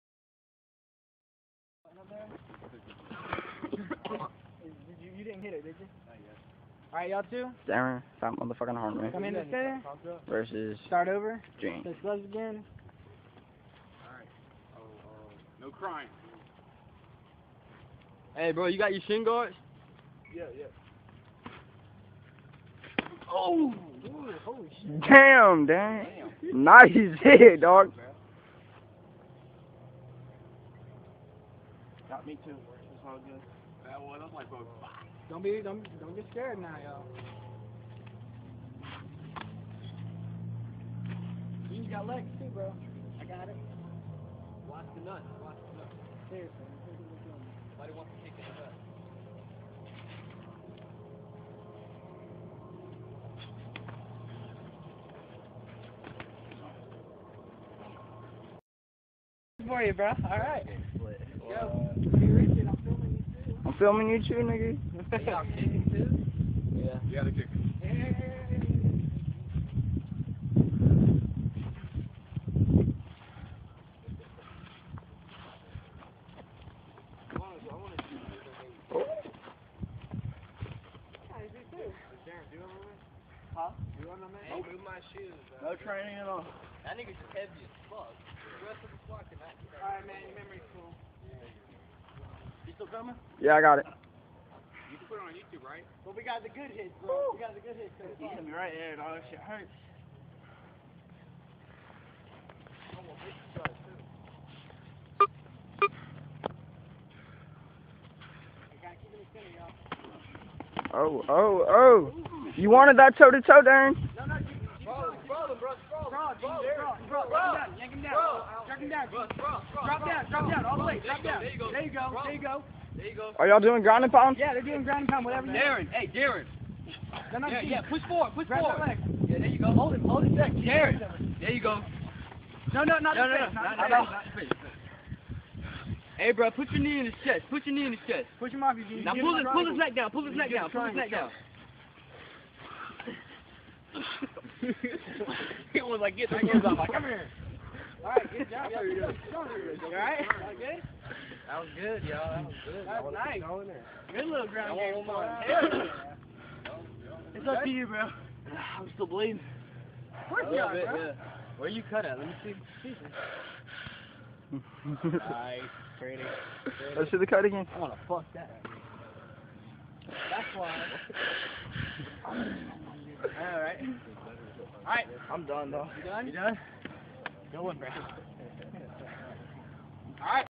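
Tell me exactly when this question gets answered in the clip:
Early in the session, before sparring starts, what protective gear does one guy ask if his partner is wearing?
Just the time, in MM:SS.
00:19.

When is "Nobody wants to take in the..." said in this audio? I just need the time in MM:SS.
00:47.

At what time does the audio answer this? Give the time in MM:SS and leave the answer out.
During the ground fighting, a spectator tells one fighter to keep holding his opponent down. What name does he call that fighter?
02:10.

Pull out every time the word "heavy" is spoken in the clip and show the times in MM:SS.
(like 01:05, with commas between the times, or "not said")
01:27.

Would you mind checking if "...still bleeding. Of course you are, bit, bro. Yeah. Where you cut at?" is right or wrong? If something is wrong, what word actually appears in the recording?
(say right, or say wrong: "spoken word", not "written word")
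right.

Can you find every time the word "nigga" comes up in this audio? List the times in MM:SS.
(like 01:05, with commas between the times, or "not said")
01:04, 01:26.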